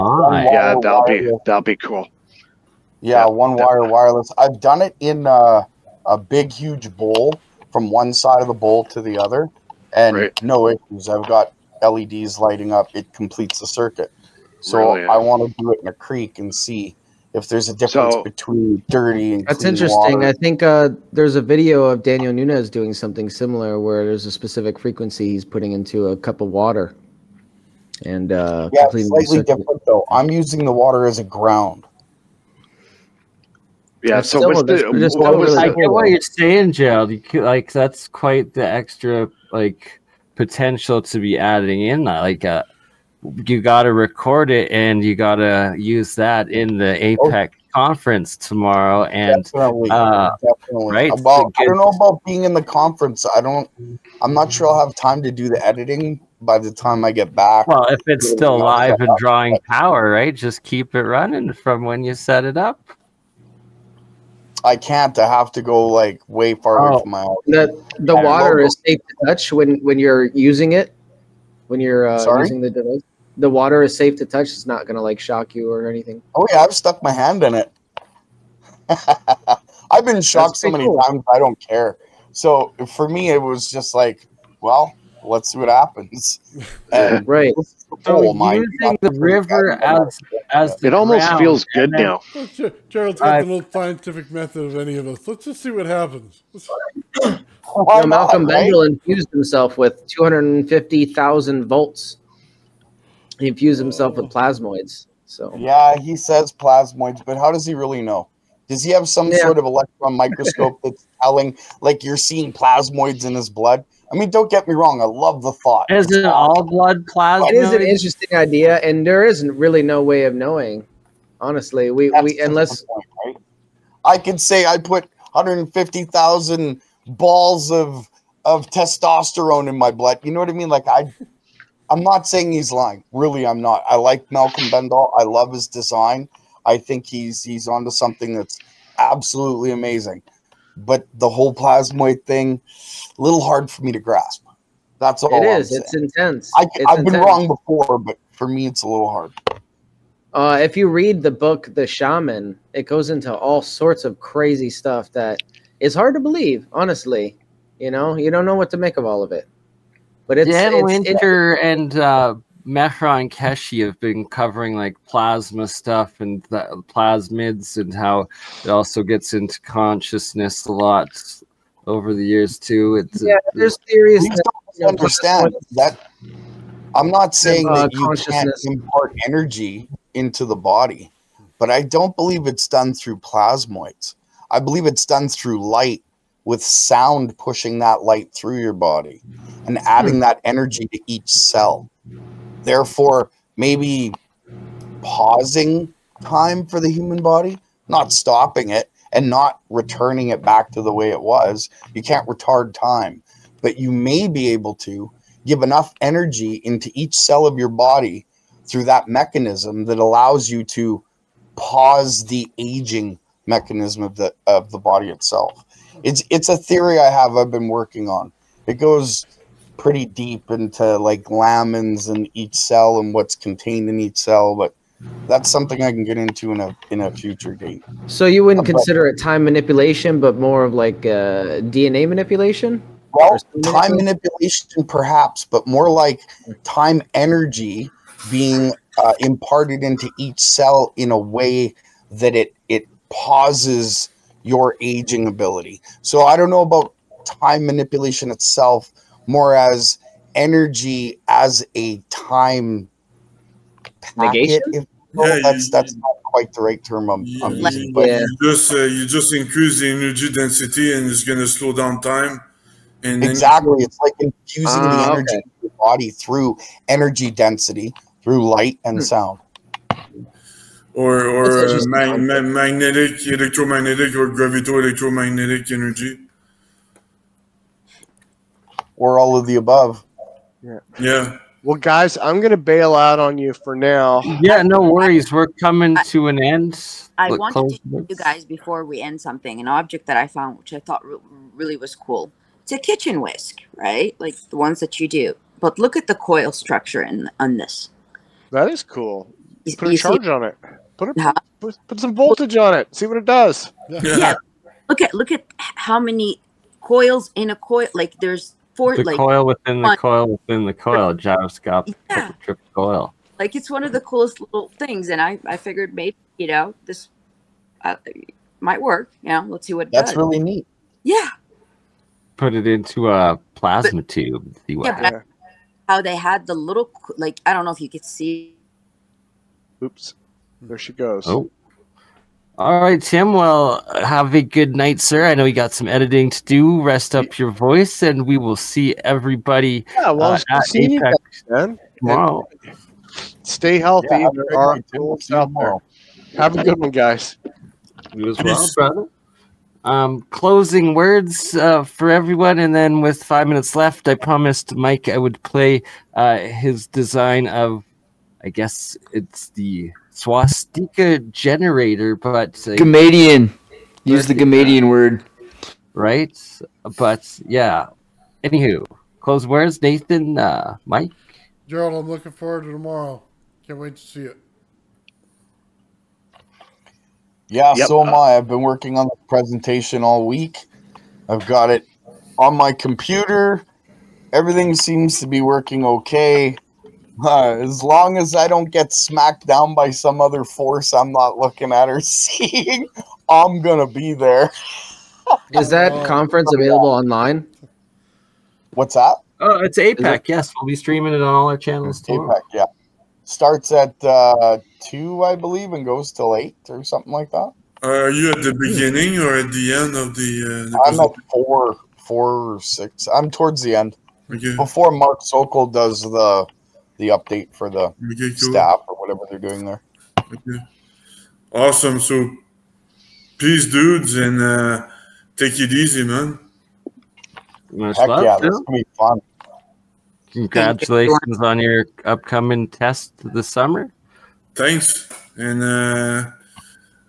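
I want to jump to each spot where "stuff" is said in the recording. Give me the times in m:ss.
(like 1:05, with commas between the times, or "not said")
2:34, 2:45.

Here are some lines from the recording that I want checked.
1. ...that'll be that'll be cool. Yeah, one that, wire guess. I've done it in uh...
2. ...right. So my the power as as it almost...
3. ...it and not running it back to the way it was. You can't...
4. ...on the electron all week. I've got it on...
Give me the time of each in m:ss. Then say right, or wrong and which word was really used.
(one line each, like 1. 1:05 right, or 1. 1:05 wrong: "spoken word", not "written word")
1. 0:00 wrong: "wireless", not "guess"
2. 1:27 wrong: "river", not "power"
3. 3:18 wrong: "returning", not "running"
4. 6:18 wrong: "presentation", not "electron".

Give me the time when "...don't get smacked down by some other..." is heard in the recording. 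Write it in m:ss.
6:28.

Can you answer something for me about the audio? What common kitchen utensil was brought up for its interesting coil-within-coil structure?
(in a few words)
kitchen whisk.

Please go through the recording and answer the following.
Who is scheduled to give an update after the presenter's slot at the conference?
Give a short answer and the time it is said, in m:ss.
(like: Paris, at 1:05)
Mark Sokol, at 6:54.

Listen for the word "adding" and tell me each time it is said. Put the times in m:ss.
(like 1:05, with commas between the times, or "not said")
0:41, 3:09.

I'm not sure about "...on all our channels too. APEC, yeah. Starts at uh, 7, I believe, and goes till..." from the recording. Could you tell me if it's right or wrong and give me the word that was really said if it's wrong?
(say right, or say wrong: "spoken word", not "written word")
wrong: "2", not "7".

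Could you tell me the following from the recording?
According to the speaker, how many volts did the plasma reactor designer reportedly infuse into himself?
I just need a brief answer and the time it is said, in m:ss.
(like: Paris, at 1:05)
250,000, at 1:40.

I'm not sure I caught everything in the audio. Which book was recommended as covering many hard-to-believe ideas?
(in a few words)
The Shaman.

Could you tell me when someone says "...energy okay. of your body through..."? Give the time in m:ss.
4:25.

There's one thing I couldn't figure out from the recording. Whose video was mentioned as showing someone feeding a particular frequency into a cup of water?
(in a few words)
Daniel Nunez.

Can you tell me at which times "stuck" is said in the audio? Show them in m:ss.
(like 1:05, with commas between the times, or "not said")
1:16.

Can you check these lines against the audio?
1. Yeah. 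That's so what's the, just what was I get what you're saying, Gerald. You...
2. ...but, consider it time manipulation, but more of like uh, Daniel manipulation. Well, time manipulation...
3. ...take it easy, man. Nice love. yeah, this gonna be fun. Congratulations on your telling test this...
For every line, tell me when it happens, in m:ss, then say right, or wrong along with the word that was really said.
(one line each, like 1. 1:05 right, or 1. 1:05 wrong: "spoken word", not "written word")
1. 0:34 right
2. 3:48 wrong: "DNA", not "Daniel"
3. 7:05 wrong: "upcoming", not "telling".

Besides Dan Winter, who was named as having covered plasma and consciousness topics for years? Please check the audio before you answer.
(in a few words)
Mehran Keshe.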